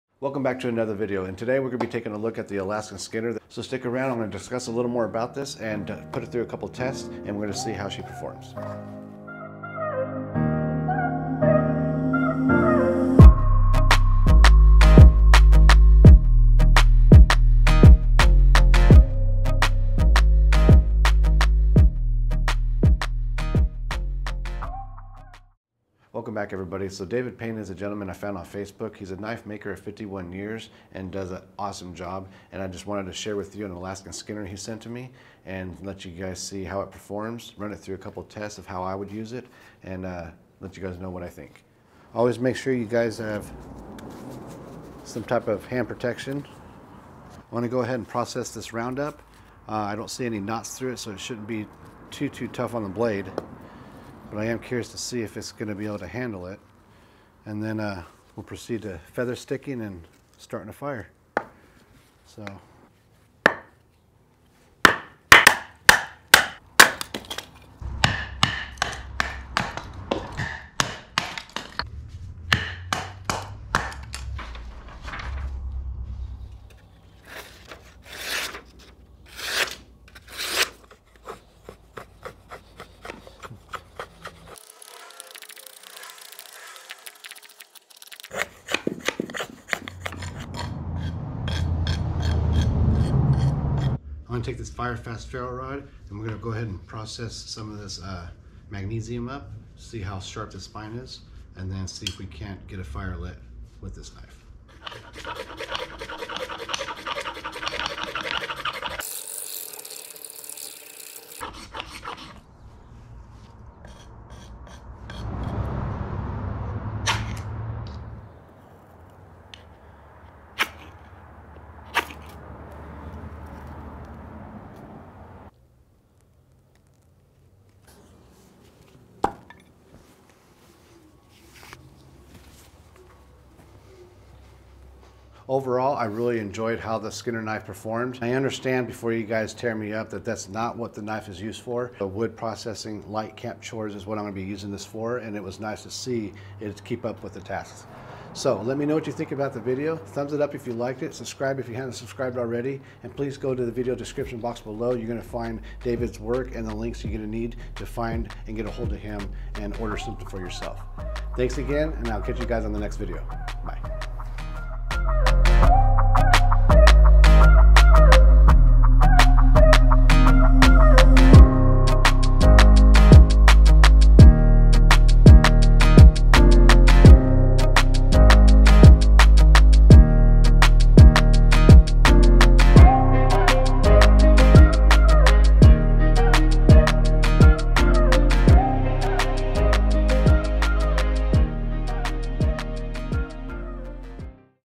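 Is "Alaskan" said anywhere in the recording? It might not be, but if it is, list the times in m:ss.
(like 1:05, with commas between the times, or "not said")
0:02, 0:33.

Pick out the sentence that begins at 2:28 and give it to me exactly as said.
So let me know what you think about the video.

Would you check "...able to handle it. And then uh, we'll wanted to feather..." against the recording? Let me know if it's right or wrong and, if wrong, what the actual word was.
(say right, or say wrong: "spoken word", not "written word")
wrong: "proceed", not "wanted".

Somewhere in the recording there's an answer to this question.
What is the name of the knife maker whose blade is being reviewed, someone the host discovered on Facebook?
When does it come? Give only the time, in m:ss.
0:27.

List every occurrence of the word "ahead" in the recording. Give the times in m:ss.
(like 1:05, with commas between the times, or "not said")
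0:47, 1:36.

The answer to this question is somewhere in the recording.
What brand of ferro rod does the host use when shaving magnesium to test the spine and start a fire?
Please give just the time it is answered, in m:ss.
1:34.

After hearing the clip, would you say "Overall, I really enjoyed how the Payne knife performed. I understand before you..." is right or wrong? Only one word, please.
wrong.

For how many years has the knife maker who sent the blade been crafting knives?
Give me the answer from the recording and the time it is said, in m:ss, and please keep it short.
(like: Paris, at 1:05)
51, at 0:29.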